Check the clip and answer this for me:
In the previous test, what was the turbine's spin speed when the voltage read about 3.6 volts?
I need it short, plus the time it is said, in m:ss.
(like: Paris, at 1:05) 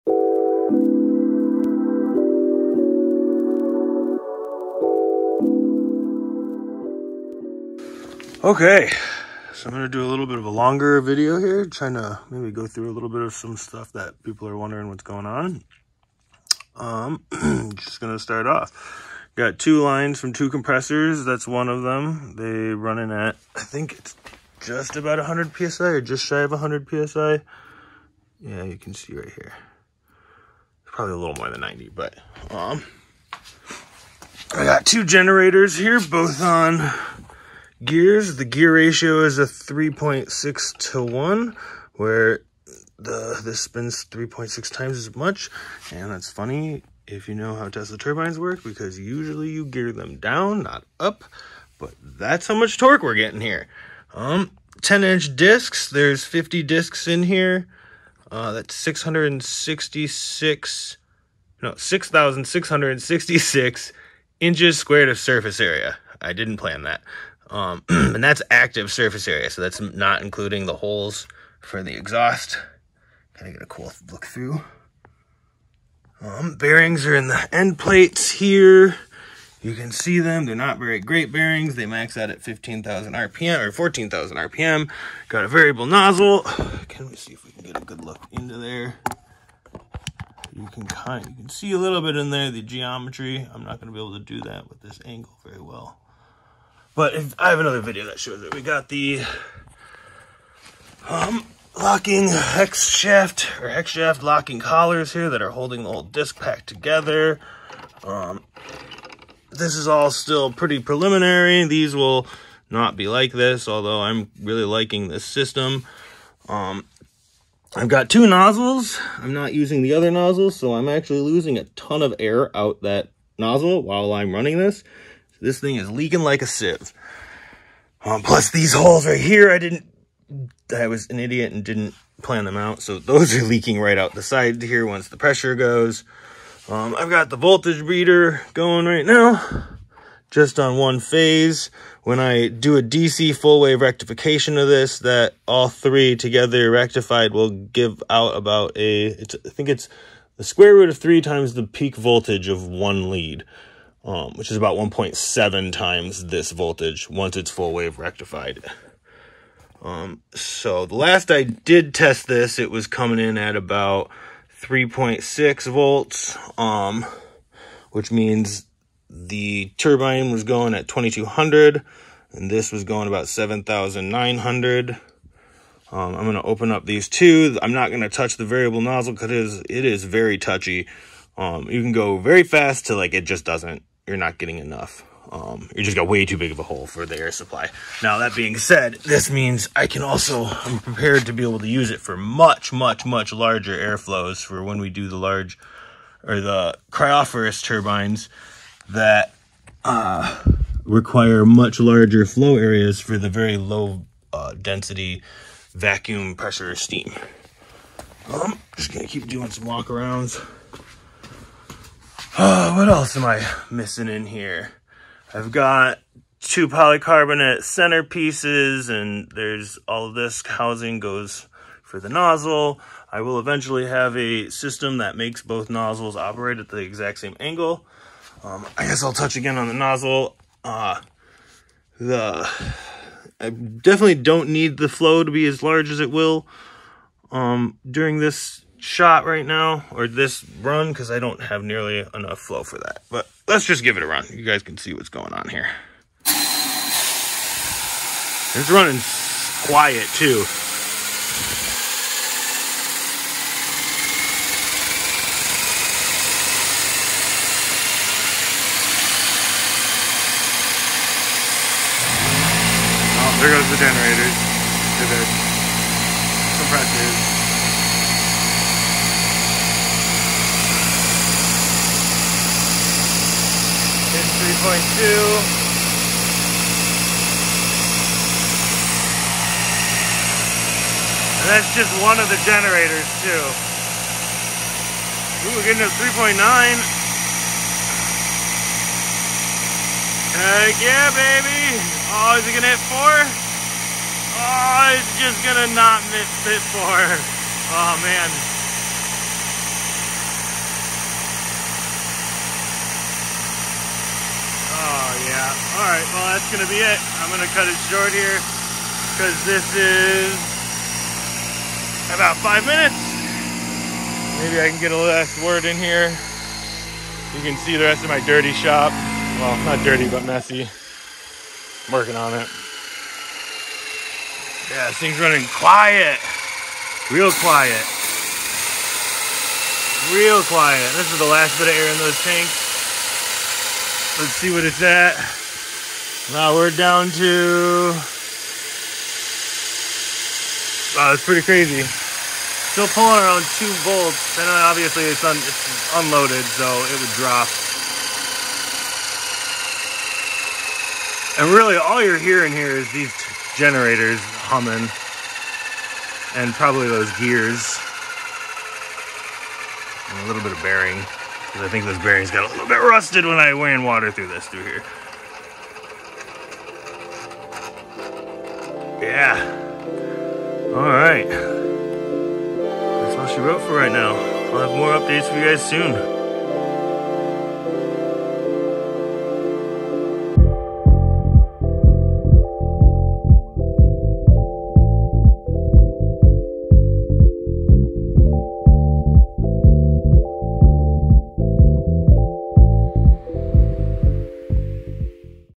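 2200, at 2:50.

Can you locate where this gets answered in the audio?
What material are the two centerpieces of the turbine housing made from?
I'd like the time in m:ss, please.
3:36.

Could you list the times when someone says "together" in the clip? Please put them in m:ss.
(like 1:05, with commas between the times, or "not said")
1:46, 2:26.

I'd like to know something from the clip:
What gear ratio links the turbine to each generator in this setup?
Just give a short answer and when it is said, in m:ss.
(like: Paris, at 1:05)
3.6 to 1, at 0:39.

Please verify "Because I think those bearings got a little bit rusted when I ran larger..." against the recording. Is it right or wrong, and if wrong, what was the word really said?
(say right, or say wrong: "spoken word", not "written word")
wrong: "water", not "larger".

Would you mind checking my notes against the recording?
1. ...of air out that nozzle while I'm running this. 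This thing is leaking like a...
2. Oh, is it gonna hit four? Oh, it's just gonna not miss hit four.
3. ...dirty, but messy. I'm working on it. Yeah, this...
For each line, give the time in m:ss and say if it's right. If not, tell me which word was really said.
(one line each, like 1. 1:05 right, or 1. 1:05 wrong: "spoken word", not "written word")
1. 2:02 right
2. 4:52 right
3. 5:19 right.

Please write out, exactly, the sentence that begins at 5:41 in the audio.
Still pulling around two volts, and obviously it's, un it's unloaded, so it would drop.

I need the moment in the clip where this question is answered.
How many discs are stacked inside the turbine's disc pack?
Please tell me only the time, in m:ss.
0:56.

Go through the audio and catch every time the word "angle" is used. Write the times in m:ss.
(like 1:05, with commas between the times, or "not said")
1:35, 3:47.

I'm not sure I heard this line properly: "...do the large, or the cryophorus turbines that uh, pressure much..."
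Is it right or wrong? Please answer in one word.
wrong.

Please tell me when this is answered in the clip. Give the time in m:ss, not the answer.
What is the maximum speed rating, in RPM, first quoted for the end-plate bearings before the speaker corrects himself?
1:22.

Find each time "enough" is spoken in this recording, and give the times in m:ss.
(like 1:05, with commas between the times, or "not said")
3:04, 4:02.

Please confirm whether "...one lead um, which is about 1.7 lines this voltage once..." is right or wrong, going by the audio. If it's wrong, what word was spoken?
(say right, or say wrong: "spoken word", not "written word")
wrong: "times", not "lines".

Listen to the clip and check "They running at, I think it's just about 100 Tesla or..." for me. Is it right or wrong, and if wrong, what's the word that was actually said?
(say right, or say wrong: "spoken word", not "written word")
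wrong: "PSI", not "Tesla".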